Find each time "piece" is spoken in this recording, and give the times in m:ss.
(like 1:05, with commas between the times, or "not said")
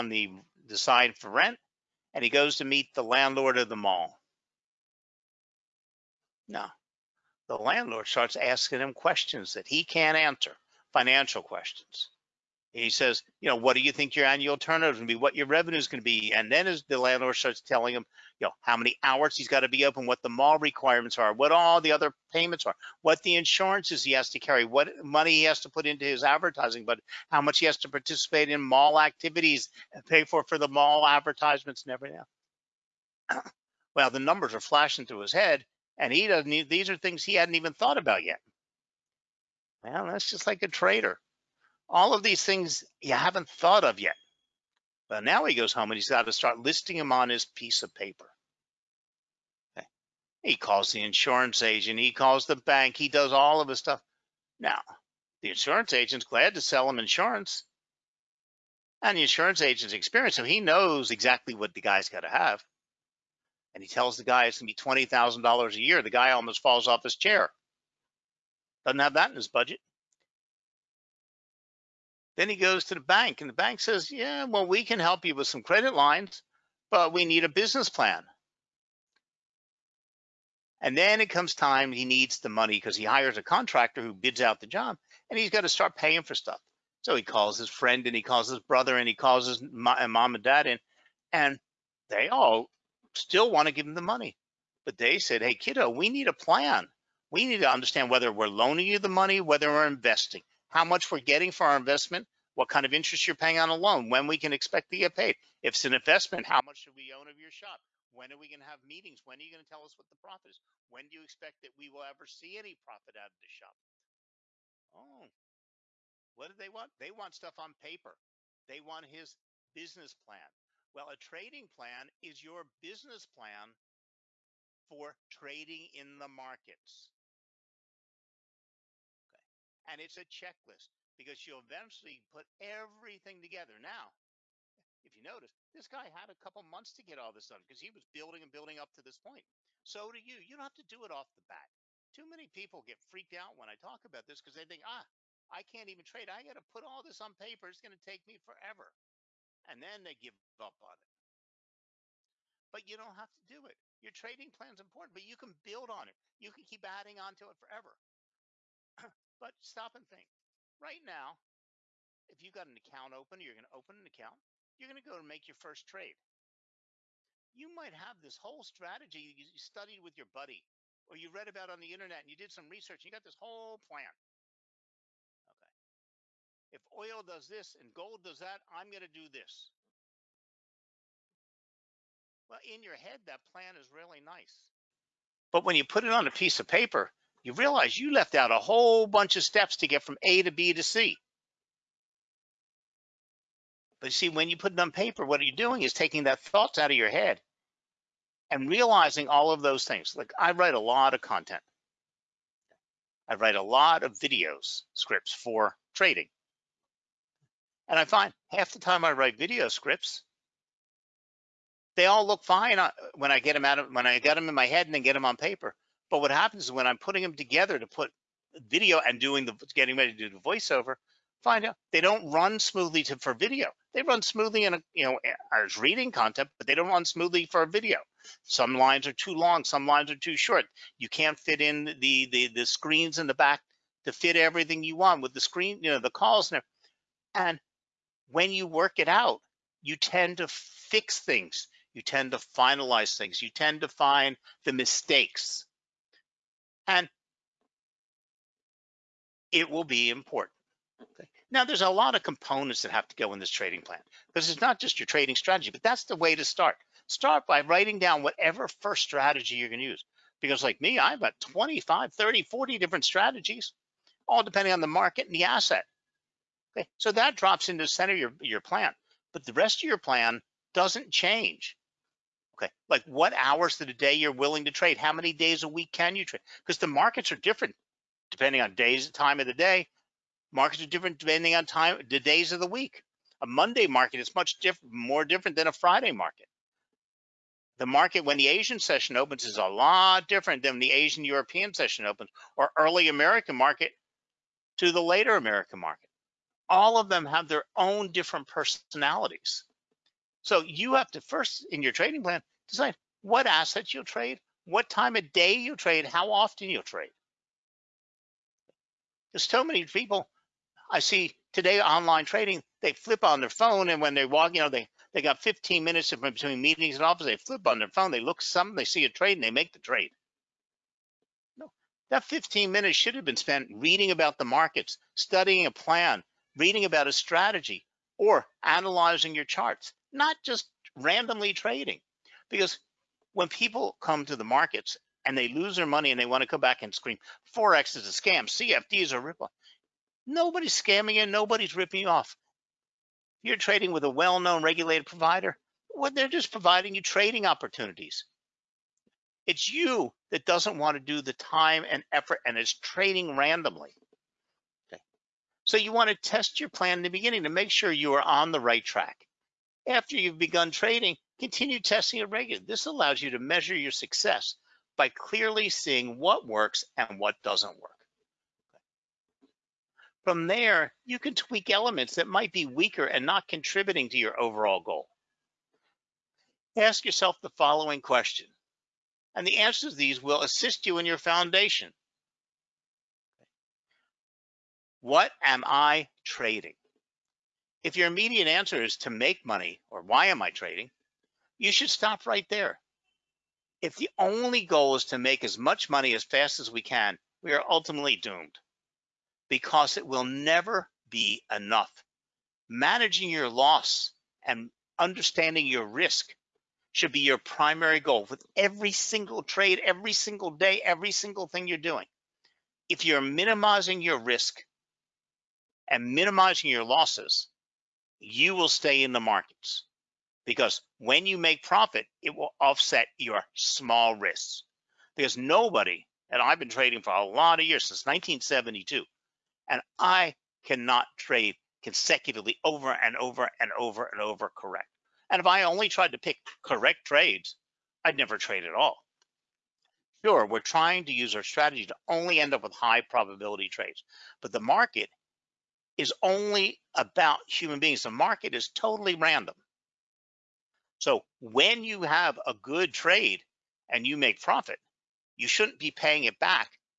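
0:47, 3:06.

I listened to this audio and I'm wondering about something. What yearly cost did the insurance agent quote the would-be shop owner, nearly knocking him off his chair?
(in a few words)
$20,000.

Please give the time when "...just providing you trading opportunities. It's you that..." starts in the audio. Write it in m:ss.
5:46.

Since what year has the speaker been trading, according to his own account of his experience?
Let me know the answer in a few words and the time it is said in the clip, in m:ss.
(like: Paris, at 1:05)
1972, at 7:08.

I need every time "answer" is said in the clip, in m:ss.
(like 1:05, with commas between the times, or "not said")
0:10, 6:19, 6:28.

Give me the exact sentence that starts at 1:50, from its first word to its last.
When do you expect that we will ever see any profit out of the shop?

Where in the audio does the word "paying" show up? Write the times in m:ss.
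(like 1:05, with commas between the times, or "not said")
1:25, 1:43, 7:35.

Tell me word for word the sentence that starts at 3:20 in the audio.
Like I write a lot of content.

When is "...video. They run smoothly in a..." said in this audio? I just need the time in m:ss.
3:43.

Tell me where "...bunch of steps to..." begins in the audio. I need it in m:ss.
3:09.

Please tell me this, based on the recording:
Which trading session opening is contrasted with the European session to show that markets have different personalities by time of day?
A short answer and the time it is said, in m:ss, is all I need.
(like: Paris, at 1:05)
Asian session, at 4:48.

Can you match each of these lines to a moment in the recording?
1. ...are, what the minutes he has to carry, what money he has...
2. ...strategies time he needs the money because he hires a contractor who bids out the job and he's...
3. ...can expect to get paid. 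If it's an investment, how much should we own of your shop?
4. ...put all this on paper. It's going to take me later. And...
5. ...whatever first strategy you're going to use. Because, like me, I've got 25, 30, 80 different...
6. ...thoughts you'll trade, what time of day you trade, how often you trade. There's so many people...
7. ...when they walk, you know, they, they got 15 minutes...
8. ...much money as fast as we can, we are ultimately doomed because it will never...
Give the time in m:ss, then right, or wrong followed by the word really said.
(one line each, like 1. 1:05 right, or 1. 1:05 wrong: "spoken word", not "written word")
1. 0:22 wrong: "insurances", not "minutes"
2. 1:21 wrong: "comes", not "strategies"
3. 1:44 right
4. 2:26 wrong: "forever", not "later"
5. 4:18 wrong: "40", not "80"
6. 5:03 wrong: "assets", not "thoughts"
7. 5:14 right
8. 6:35 right.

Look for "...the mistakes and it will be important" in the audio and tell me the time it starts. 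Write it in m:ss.
4:04.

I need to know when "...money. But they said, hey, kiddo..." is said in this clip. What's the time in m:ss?
1:34.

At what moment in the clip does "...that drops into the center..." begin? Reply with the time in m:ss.
4:27.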